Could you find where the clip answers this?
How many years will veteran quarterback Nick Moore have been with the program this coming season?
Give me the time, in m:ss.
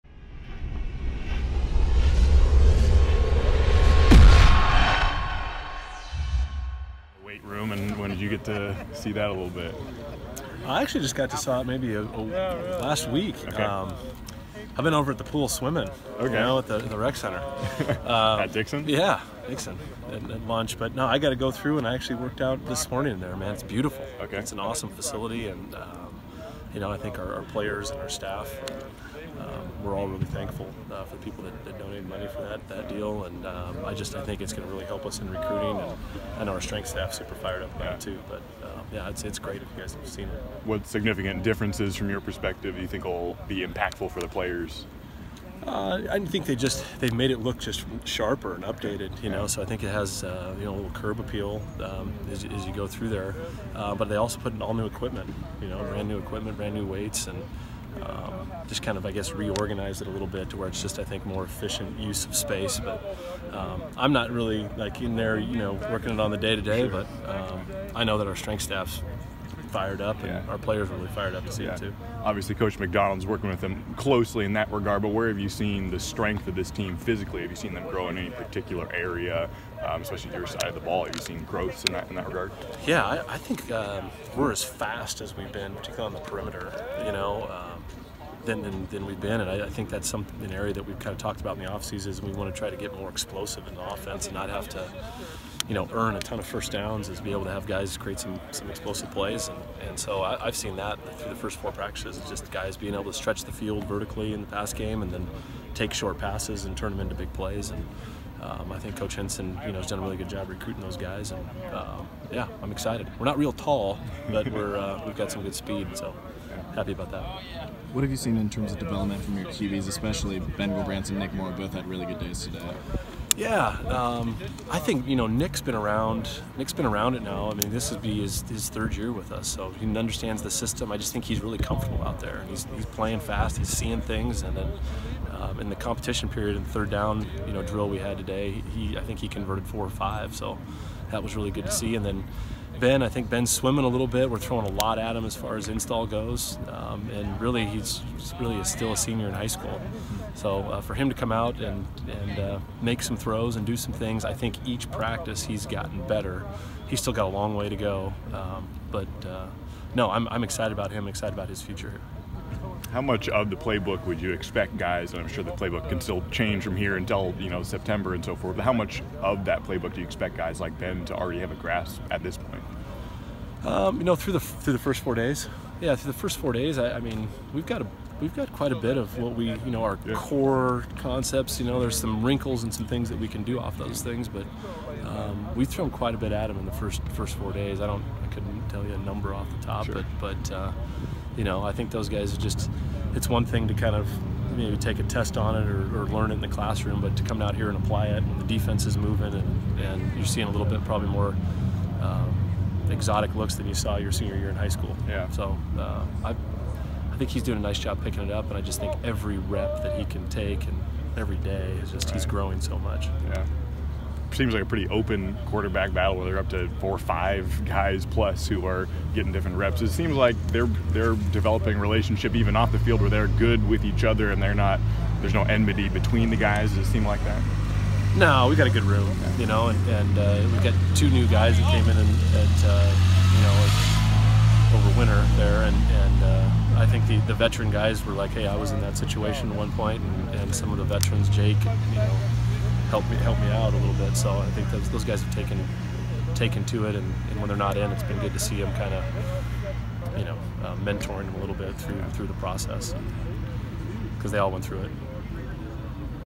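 2:08.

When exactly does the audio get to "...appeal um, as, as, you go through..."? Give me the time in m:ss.
0:51.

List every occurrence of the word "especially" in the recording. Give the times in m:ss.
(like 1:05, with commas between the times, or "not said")
1:20, 1:59.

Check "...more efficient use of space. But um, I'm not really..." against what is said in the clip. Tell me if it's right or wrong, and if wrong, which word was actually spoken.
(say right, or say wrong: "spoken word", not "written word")
right.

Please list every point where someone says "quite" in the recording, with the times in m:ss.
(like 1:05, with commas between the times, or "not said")
2:58, 3:05.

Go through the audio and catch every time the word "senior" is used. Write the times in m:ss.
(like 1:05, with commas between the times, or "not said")
2:28, 3:24.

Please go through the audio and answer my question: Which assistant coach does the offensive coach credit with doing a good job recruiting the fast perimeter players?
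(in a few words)
Coach Hynson.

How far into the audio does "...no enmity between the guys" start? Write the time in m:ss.
3:45.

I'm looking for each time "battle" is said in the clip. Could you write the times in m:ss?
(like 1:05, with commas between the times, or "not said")
3:35.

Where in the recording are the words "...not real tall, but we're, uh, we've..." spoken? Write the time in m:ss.
1:53.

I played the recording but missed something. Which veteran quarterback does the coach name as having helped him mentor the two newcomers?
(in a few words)
Jake.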